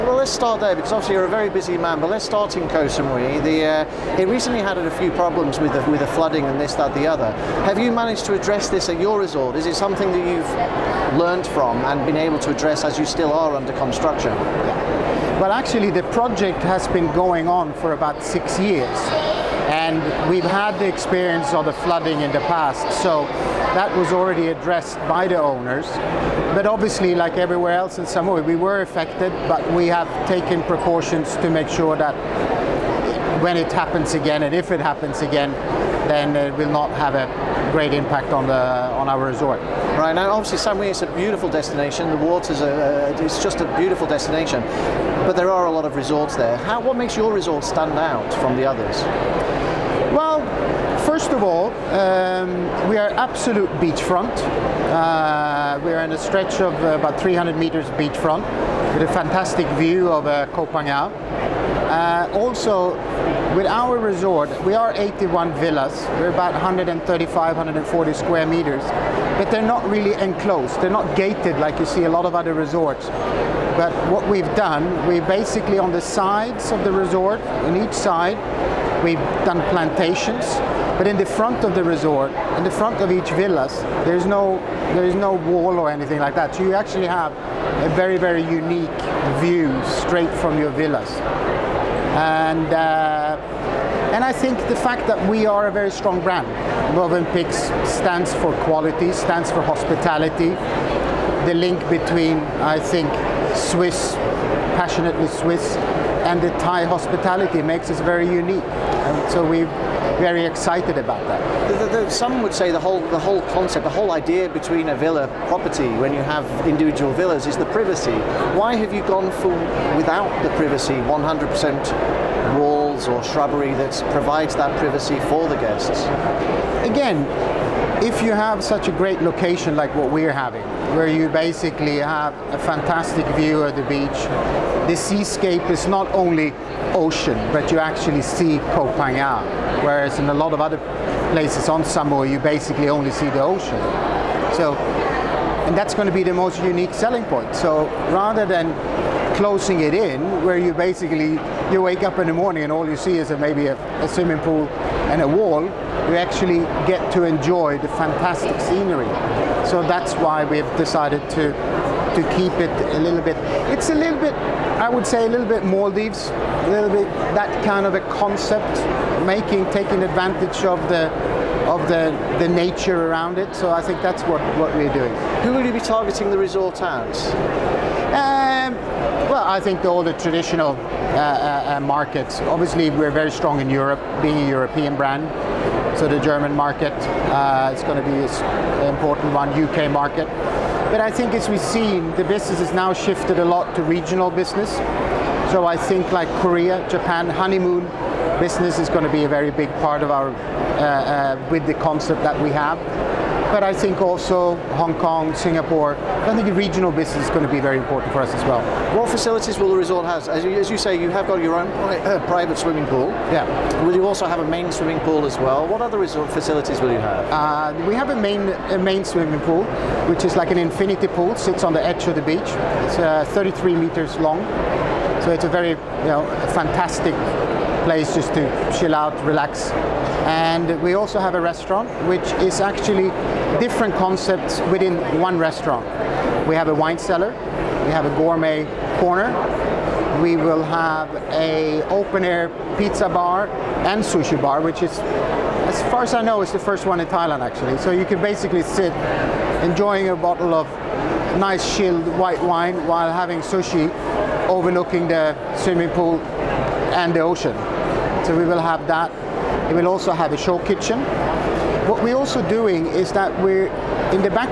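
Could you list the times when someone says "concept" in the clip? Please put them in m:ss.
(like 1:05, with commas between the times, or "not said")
1:53, 2:48, 3:21, 3:53.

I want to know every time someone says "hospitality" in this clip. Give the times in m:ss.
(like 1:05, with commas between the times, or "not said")
1:39, 1:46.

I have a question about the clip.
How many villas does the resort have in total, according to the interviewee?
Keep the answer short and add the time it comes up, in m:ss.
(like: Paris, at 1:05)
81, at 1:04.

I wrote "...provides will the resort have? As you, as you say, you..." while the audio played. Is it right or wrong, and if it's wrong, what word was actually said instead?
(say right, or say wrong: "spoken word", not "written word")
wrong: "facilities", not "provides".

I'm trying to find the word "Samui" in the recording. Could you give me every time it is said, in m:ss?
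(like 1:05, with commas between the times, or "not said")
0:02, 0:28, 0:40, 2:21.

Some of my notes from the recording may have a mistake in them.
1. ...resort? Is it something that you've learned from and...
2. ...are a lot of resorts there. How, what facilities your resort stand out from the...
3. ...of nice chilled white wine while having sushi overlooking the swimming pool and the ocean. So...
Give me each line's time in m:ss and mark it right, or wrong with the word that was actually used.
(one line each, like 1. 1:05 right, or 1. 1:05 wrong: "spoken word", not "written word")
1. 0:09 right
2. 0:45 wrong: "makes", not "facilities"
3. 4:10 right.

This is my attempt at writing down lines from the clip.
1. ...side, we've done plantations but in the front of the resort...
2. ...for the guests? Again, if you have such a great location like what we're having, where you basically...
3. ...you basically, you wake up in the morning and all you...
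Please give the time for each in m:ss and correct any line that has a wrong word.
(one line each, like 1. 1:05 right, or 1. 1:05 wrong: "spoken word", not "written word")
1. 1:17 right
2. 2:05 right
3. 2:30 right.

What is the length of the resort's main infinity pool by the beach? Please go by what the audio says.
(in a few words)
33 meters.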